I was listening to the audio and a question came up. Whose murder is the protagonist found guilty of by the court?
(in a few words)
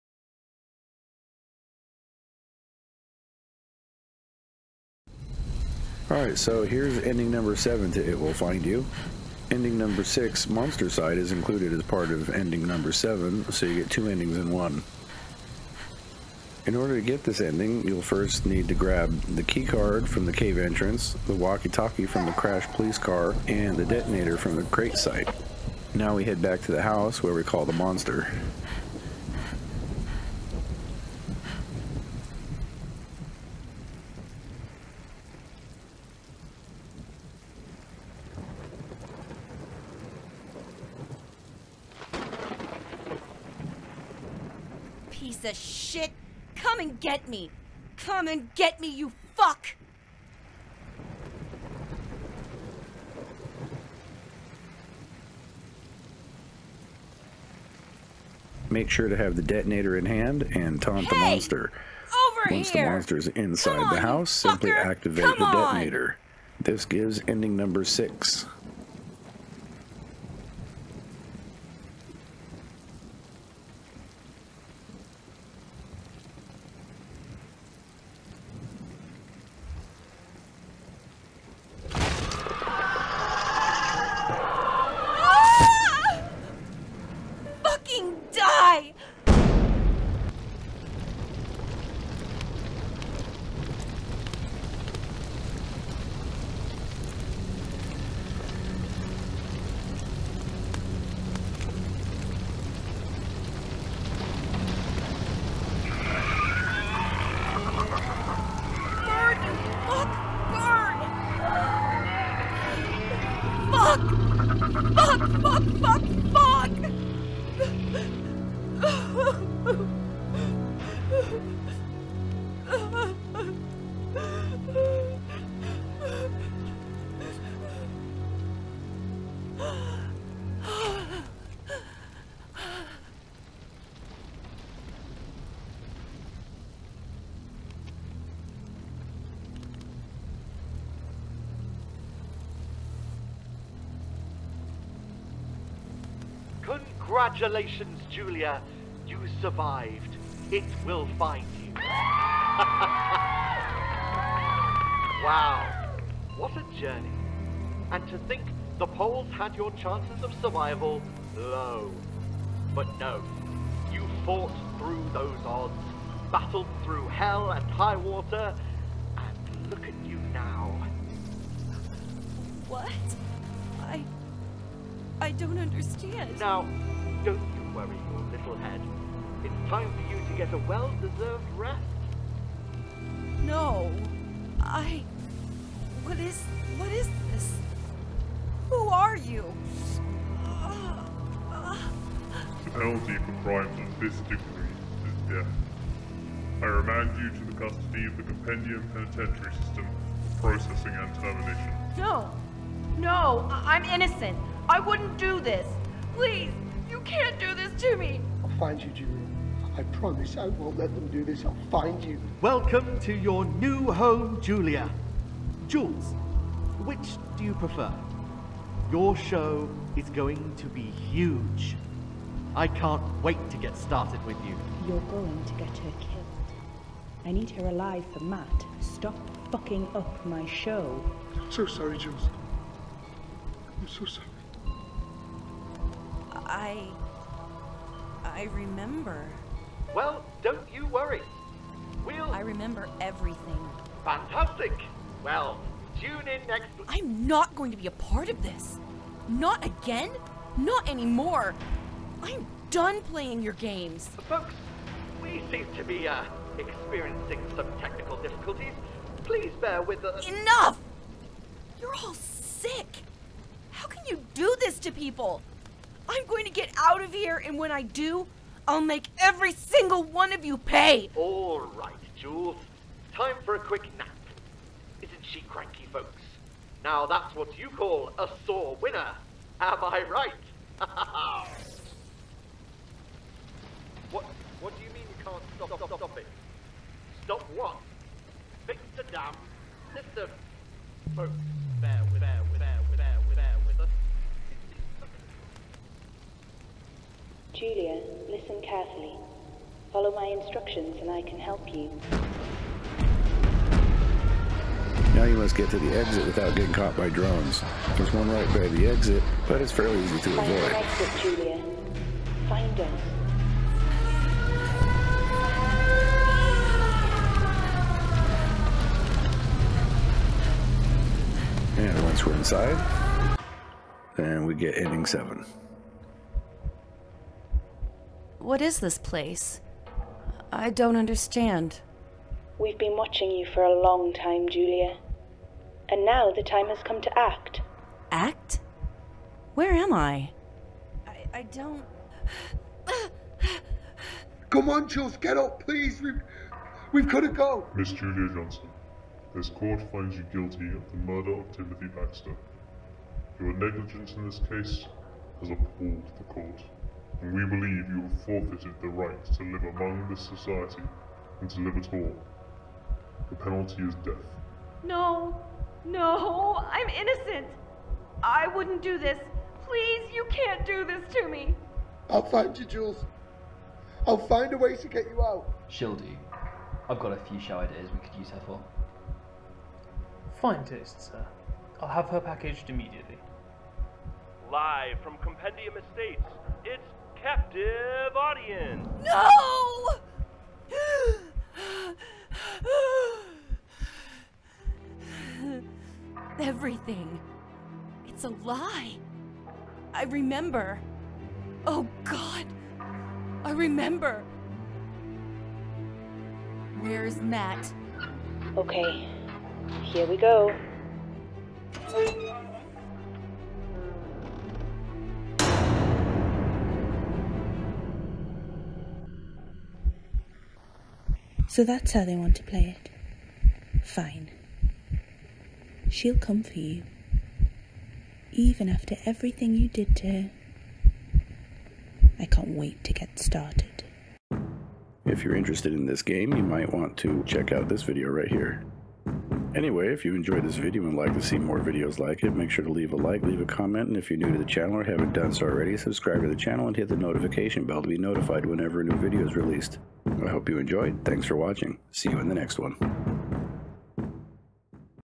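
Timothy Baxter.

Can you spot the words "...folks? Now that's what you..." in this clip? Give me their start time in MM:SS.
04:35.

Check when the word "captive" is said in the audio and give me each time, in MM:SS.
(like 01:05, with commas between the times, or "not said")
06:27.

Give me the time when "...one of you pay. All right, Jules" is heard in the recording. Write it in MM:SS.
04:30.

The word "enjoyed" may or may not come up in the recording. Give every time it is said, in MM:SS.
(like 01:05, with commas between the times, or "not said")
07:20, 07:30.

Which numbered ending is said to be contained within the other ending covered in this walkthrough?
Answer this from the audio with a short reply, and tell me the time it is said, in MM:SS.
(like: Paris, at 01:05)
Monstercide, at 00:10.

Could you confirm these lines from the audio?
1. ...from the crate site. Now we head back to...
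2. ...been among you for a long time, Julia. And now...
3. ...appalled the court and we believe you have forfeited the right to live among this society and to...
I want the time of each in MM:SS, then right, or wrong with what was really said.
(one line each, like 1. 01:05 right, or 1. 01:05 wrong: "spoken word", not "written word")
1. 00:24 right
2. 05:32 wrong: "watching", not "among"
3. 05:55 right.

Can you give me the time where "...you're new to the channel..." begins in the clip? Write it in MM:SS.
07:24.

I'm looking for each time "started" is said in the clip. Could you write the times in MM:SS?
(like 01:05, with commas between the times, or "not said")
03:43, 07:13.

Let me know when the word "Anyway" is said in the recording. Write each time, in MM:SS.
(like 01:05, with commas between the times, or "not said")
07:19.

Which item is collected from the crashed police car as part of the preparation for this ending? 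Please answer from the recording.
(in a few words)
walkie-talkie.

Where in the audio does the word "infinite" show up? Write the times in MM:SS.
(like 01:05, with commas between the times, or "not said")
not said.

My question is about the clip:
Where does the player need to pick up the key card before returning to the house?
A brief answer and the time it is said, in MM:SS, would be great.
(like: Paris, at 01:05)
the cave entrance, at 00:20.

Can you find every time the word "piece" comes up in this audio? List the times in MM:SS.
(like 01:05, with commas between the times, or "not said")
00:45.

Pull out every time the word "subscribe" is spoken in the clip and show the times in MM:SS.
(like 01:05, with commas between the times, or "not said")
07:25.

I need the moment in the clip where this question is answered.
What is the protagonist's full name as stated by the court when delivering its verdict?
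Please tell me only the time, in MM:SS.
05:47.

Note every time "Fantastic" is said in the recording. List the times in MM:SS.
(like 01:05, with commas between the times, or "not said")
04:04.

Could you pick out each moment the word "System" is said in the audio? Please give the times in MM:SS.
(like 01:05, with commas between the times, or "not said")
03:19.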